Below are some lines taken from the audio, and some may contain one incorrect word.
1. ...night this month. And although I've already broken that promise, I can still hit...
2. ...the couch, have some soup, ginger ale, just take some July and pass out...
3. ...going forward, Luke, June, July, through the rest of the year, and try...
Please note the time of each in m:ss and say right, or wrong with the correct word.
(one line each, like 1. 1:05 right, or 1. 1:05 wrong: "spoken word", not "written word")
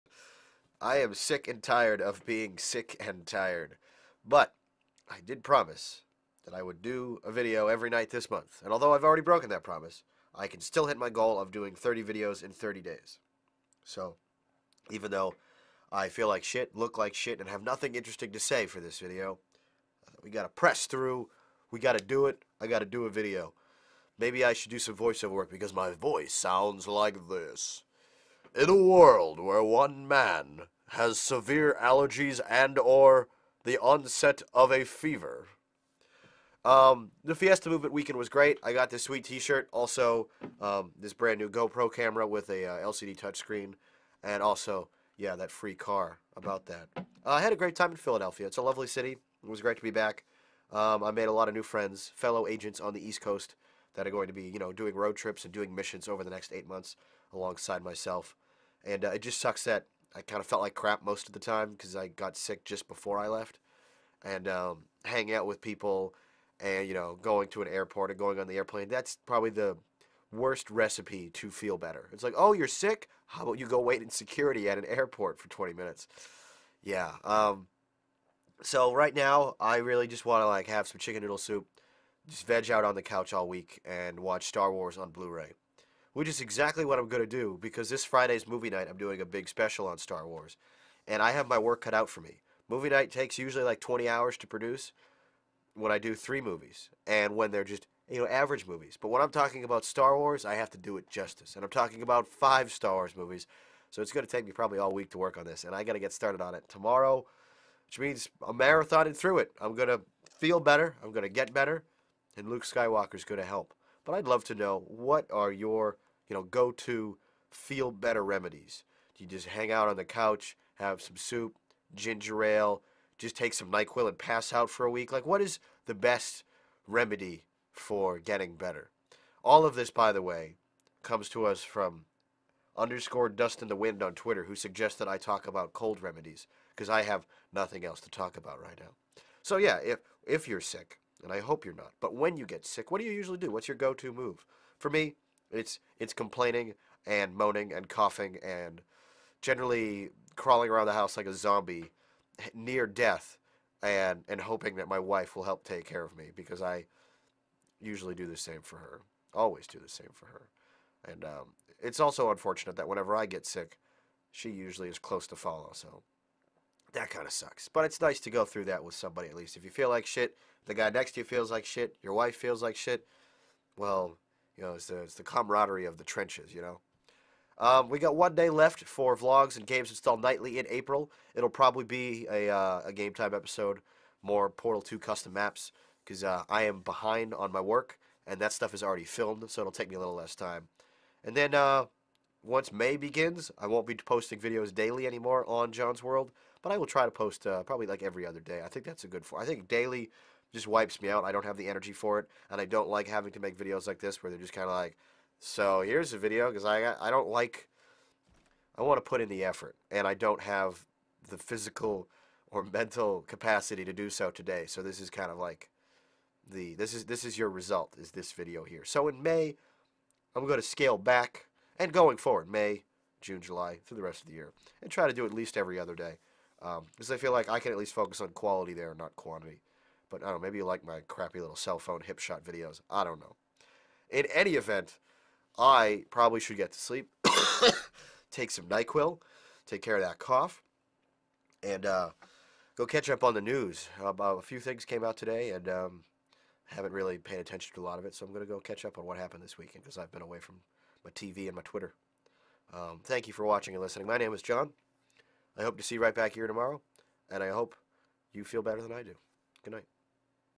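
1. 0:07 right
2. 1:59 wrong: "NyQuil", not "July"
3. 3:41 wrong: "May", not "Luke".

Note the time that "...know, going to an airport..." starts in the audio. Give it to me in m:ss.
1:06.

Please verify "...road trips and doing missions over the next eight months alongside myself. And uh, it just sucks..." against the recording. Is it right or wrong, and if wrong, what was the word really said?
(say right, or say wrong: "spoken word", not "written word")
right.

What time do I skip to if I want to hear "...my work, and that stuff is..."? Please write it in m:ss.
3:07.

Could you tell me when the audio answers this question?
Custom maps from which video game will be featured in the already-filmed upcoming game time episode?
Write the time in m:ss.
3:04.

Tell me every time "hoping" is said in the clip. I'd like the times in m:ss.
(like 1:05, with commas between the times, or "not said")
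2:34.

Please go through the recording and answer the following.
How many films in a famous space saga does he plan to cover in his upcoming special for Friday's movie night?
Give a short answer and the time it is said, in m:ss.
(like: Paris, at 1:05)
5, at 1:42.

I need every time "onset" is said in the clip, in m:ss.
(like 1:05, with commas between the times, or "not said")
0:33.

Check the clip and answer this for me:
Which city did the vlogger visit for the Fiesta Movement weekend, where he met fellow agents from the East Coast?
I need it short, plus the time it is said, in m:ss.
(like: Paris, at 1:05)
Philadelphia, at 0:47.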